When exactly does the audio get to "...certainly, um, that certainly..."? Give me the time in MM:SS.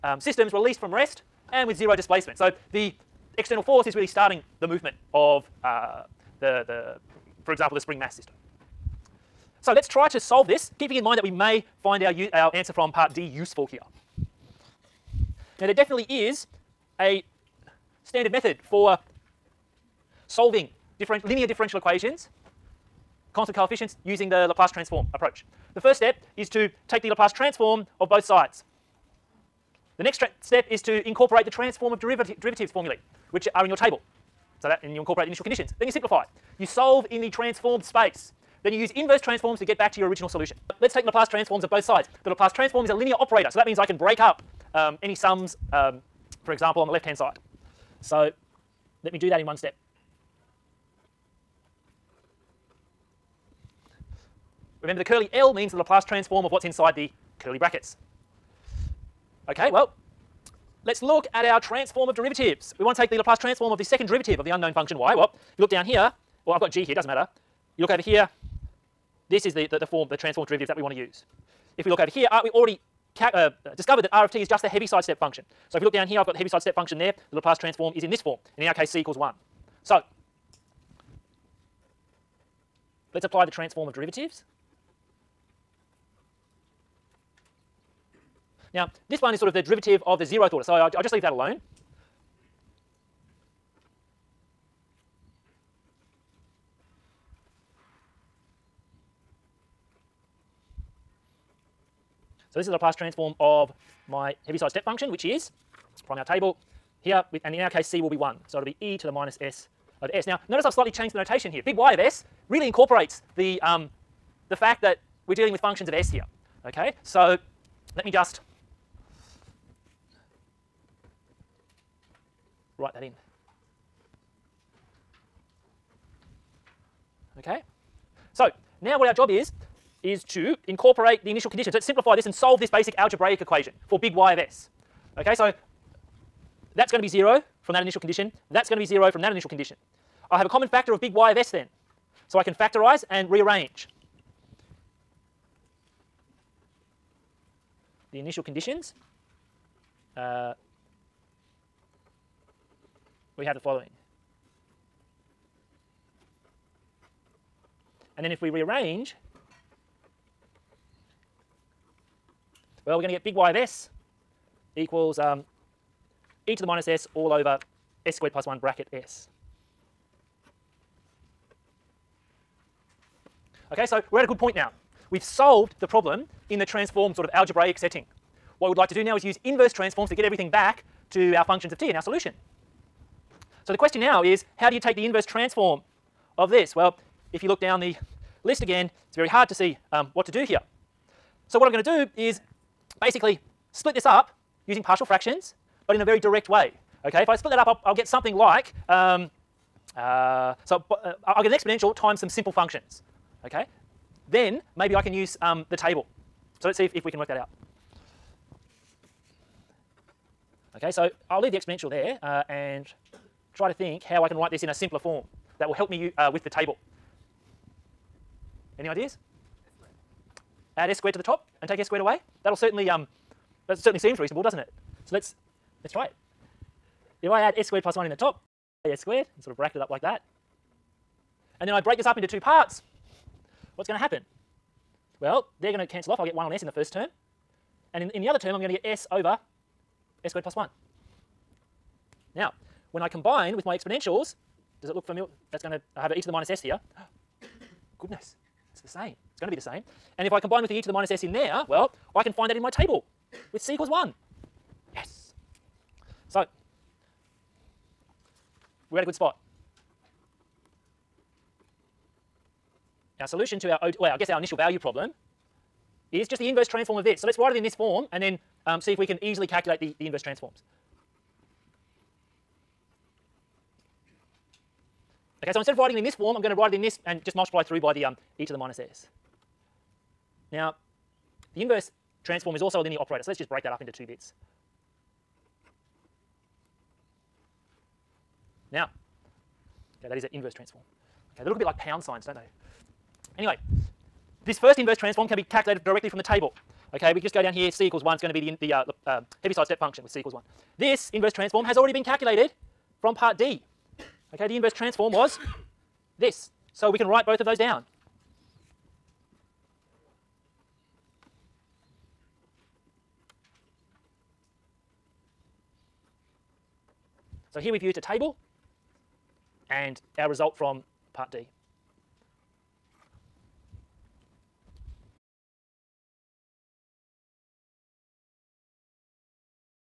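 03:42.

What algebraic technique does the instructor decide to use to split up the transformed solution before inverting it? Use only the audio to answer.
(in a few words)
partial fractions.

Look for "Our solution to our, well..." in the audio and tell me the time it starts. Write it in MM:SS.
04:23.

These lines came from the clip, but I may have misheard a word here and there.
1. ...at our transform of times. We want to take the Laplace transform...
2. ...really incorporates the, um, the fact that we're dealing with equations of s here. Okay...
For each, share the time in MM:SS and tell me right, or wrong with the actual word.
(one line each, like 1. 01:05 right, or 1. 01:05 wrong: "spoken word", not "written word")
1. 01:01 wrong: "derivatives", not "times"
2. 01:52 wrong: "functions", not "equations".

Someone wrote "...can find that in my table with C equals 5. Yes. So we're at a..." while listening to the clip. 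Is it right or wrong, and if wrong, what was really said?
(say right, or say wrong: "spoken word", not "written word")
wrong: "1", not "5".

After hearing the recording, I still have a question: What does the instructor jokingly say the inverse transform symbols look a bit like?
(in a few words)
pound signs.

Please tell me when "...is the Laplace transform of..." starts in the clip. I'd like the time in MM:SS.
01:42.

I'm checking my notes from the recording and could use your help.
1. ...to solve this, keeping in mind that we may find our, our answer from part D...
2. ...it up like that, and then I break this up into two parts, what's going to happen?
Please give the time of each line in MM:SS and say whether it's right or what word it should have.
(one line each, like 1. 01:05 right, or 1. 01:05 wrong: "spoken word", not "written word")
1. 00:10 right
2. 03:49 right.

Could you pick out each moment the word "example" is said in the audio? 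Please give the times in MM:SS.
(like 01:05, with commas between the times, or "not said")
00:07, 00:46.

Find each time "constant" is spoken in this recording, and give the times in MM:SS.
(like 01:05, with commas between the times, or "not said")
00:23.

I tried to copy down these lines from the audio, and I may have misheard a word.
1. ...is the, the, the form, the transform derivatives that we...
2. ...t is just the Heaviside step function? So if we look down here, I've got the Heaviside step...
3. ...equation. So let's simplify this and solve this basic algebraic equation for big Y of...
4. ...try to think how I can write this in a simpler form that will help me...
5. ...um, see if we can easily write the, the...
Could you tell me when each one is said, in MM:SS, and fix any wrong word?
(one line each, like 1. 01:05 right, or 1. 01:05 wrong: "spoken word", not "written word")
1. 01:09 right
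2. 01:14 right
3. 02:11 wrong: "condition", not "equation"
4. 03:33 right
5. 04:28 wrong: "calculate", not "write".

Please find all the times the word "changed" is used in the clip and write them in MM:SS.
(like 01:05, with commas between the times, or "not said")
01:50.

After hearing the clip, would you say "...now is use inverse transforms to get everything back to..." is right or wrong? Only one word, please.
right.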